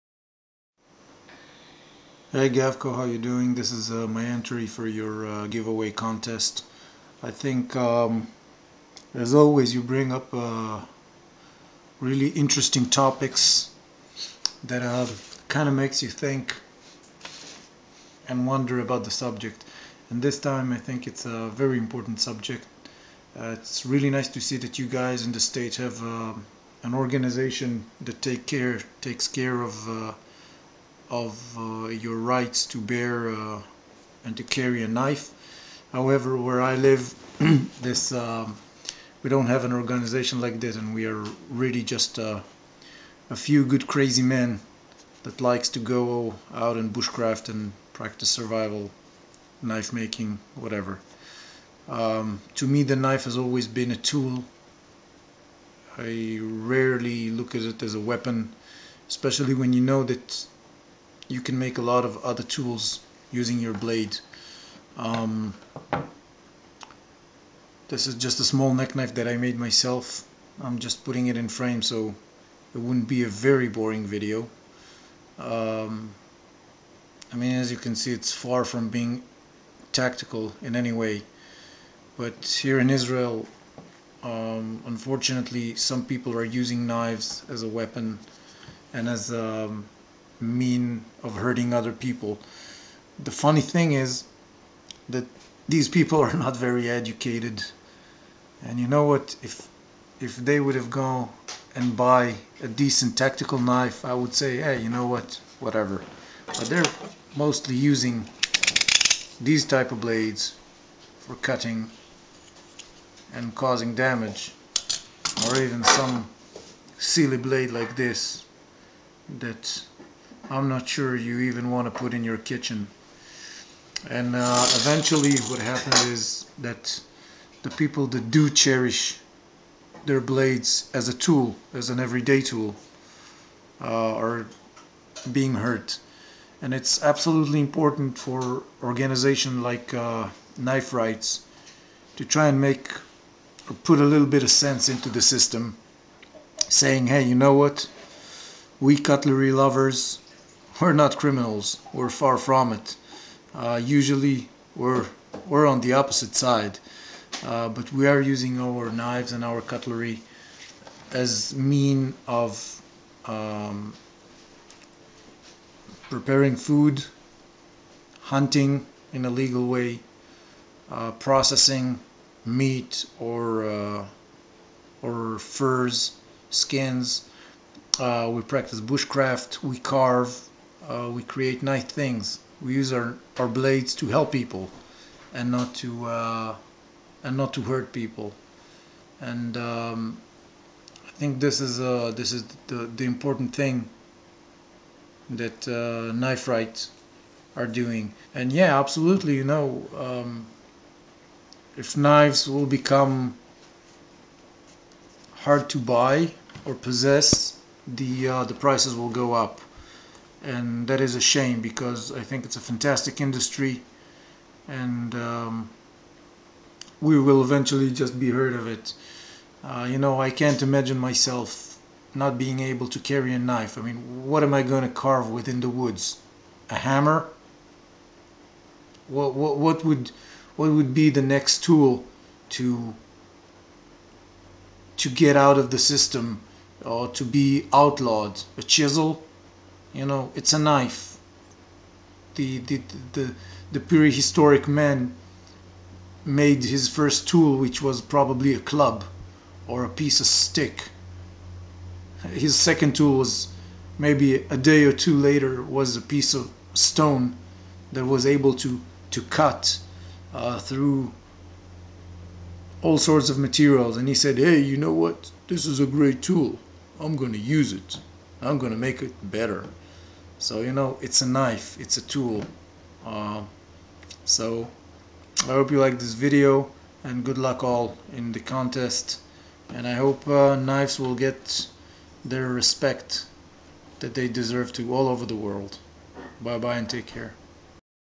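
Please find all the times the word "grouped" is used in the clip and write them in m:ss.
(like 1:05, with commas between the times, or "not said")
not said.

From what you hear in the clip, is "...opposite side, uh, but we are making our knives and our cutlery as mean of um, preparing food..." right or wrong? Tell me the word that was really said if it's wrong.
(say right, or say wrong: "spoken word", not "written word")
wrong: "using", not "making".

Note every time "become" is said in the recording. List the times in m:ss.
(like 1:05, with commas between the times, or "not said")
3:22.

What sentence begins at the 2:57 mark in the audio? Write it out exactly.
Uh, we practice bushcraft, we carve, uh, we create nice things.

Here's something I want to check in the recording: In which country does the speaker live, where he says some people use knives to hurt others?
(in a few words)
Israel.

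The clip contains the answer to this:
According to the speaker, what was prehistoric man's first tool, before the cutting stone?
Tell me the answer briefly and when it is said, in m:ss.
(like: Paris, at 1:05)
A club, at 4:08.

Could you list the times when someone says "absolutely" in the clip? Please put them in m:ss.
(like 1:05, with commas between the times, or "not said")
2:17, 3:18.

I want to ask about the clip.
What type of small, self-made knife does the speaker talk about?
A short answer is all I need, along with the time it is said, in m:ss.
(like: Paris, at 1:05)
Neck knife, at 1:08.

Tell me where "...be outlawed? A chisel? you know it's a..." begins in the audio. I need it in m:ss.
3:57.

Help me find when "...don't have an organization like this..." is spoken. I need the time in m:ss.
0:39.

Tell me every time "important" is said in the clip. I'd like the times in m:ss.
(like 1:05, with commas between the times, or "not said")
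0:21, 2:17, 3:13.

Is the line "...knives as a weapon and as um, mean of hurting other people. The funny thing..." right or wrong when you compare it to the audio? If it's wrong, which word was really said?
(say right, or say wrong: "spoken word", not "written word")
right.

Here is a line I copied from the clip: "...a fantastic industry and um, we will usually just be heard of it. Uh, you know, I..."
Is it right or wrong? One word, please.
wrong.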